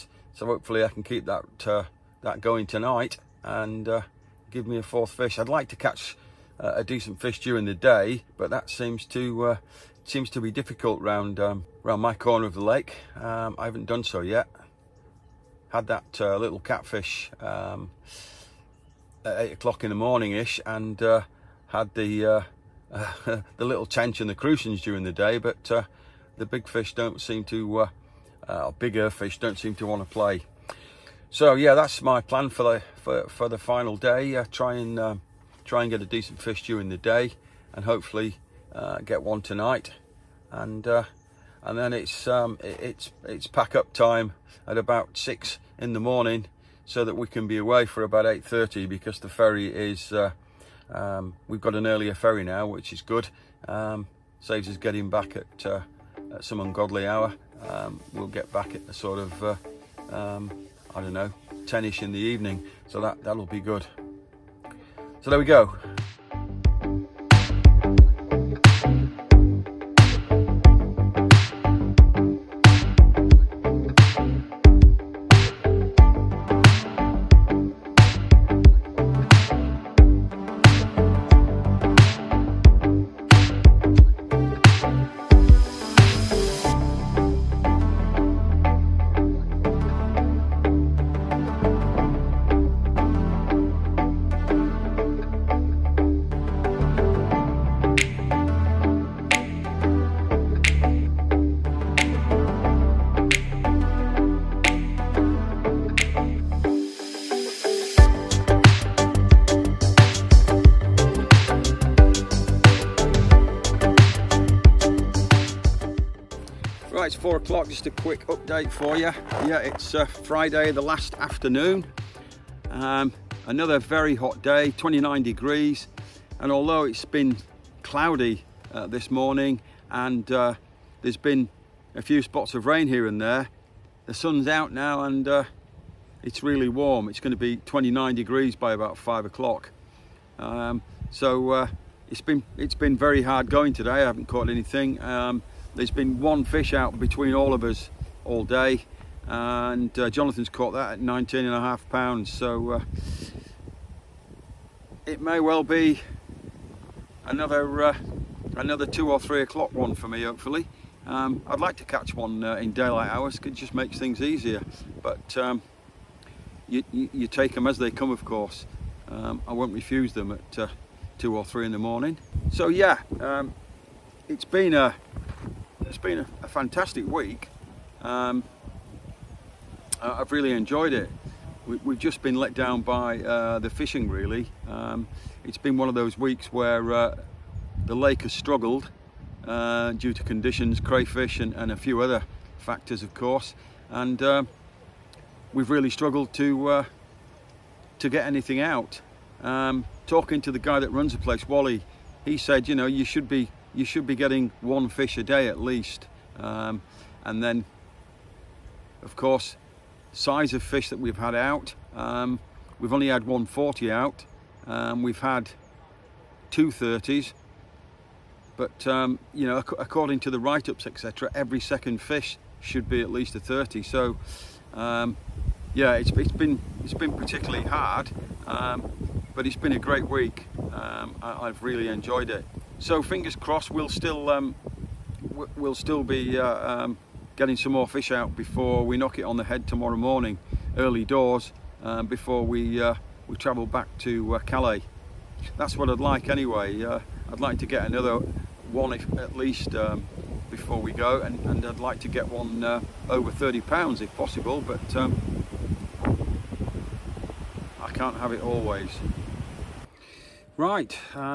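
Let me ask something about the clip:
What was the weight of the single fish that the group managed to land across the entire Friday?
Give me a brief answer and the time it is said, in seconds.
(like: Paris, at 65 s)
19 and a half pounds, at 151 s.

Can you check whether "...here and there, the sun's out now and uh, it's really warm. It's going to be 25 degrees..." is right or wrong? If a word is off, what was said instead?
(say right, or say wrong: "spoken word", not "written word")
wrong: "29", not "25".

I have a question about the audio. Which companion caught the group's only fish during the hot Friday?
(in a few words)
Jonathan.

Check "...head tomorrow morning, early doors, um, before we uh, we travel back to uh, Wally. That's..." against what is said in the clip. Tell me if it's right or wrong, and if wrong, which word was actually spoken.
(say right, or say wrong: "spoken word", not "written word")
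wrong: "Calais", not "Wally".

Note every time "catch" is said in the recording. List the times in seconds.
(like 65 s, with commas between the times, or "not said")
5 s, 161 s.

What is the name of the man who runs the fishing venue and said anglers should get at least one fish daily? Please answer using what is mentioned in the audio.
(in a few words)
Wally.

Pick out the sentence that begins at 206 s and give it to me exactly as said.
Um, and then, of course, size of fish that we've had out.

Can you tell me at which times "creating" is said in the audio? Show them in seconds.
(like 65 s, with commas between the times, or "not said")
not said.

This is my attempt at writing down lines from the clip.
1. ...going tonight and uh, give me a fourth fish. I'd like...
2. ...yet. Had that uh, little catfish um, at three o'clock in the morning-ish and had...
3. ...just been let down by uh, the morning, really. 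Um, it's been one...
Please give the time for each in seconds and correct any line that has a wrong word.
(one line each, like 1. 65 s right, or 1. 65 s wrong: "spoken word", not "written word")
1. 2 s right
2. 14 s wrong: "eight", not "three"
3. 181 s wrong: "fishing", not "morning".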